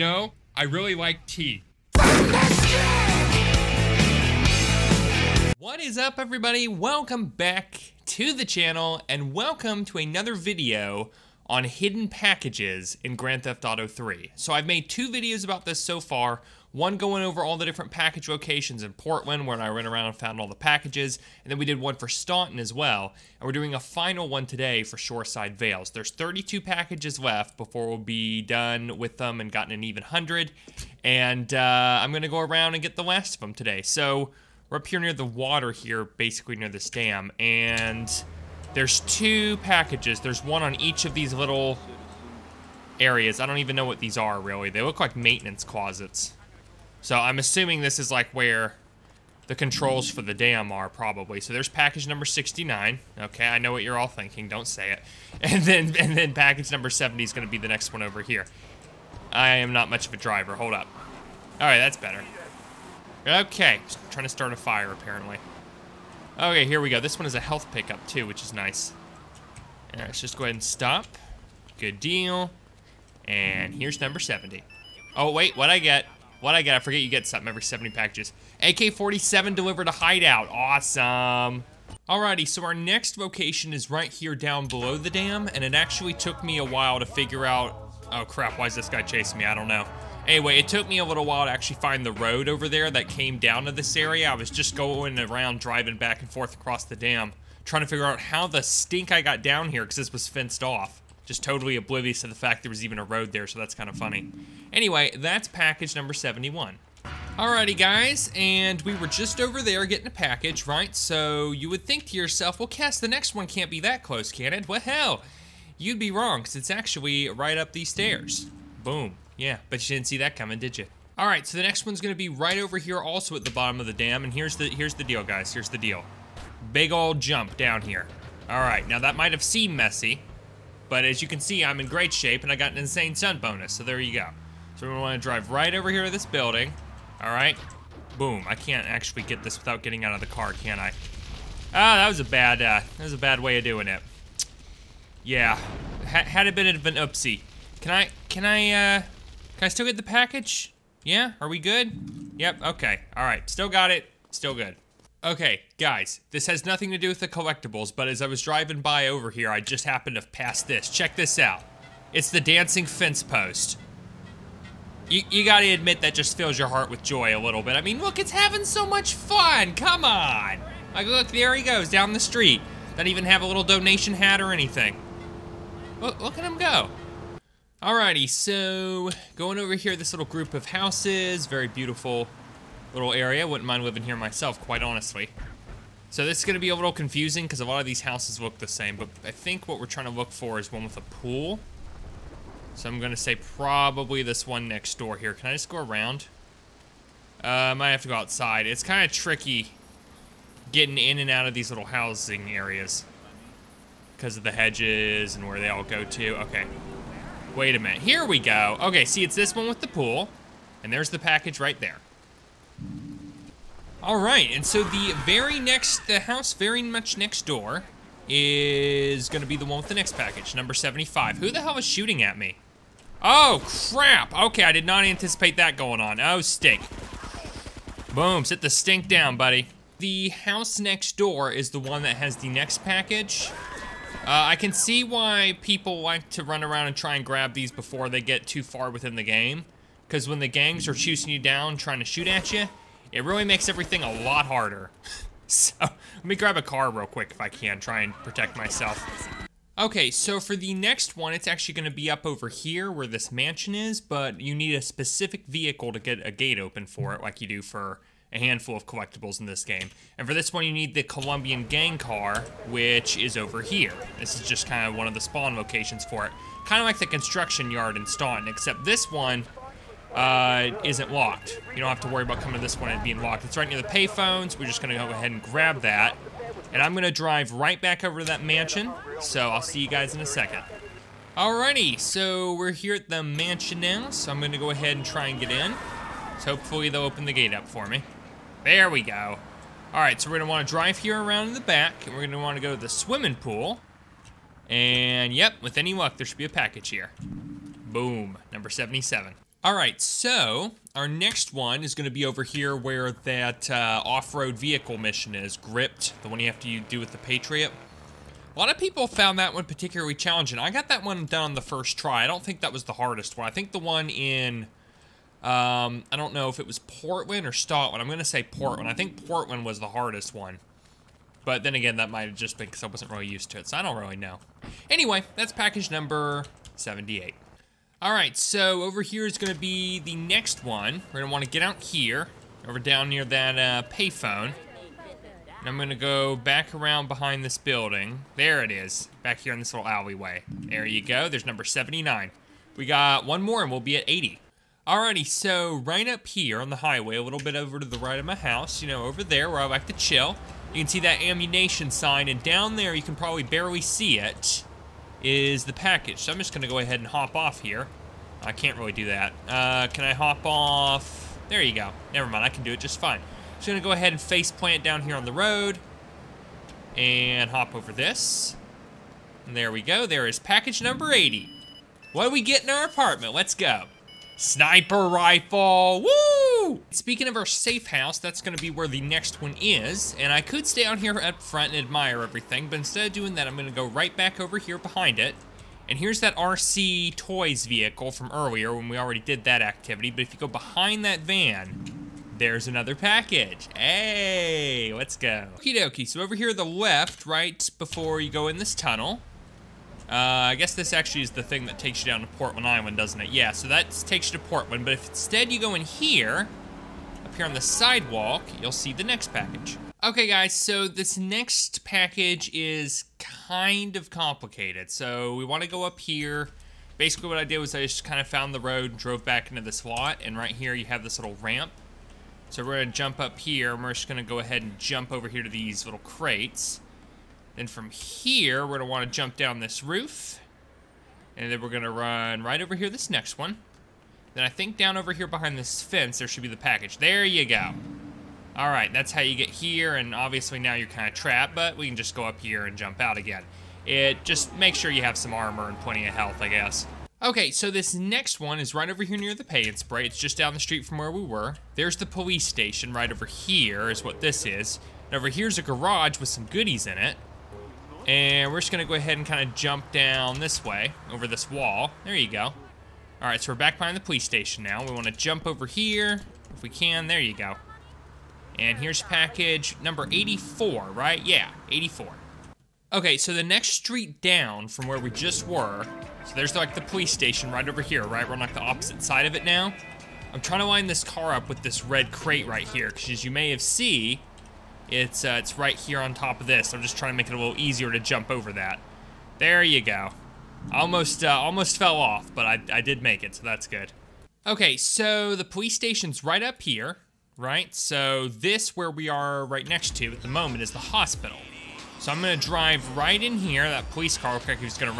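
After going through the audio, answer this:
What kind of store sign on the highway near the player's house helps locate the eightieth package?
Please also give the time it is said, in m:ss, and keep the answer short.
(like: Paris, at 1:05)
ammunition, at 5:51.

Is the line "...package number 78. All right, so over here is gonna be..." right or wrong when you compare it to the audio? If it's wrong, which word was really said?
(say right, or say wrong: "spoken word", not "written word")
right.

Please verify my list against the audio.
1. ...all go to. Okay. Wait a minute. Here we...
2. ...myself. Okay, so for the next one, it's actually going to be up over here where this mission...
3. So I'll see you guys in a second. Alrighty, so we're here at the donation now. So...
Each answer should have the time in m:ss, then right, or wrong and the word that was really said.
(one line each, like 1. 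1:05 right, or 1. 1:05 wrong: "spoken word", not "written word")
1. 3:25 right
2. 4:08 wrong: "mansion", not "mission"
3. 4:39 wrong: "mansion", not "donation".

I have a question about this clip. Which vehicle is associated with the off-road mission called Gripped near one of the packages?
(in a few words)
Patriot.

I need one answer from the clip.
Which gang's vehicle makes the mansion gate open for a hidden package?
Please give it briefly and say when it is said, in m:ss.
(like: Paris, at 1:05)
Colombian, at 4:21.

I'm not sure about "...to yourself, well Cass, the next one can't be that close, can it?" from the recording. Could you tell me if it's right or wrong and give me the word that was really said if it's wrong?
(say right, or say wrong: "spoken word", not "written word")
right.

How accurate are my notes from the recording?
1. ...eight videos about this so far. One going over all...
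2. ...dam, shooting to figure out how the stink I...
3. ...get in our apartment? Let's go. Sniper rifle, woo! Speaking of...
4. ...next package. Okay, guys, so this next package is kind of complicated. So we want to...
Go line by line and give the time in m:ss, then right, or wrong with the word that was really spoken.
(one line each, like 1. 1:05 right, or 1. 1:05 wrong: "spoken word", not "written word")
1. 0:14 wrong: "two", not "eight"
2. 1:36 wrong: "trying", not "shooting"
3. 6:12 right
4. 6:49 right.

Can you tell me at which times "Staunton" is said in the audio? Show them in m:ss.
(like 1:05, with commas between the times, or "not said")
0:22, 4:28, 5:17.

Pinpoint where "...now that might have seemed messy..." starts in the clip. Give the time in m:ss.
2:08.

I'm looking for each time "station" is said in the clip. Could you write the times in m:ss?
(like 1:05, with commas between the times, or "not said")
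7:32, 7:44, 7:57, 8:15.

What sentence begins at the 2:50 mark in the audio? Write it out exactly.
Like, look, there he goes down the street.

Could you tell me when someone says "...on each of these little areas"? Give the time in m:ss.
0:40.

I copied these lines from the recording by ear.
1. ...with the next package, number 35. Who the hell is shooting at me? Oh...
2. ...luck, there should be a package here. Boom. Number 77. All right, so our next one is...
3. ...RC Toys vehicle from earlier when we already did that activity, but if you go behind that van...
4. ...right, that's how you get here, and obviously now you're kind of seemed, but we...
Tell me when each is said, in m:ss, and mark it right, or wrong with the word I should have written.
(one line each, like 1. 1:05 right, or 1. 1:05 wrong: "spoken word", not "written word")
1. 3:39 wrong: "75", not "35"
2. 4:55 right
3. 6:26 right
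4. 7:18 wrong: "trapped", not "seemed".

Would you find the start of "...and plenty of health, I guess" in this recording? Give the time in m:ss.
7:25.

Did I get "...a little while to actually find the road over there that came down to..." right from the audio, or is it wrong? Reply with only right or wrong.
right.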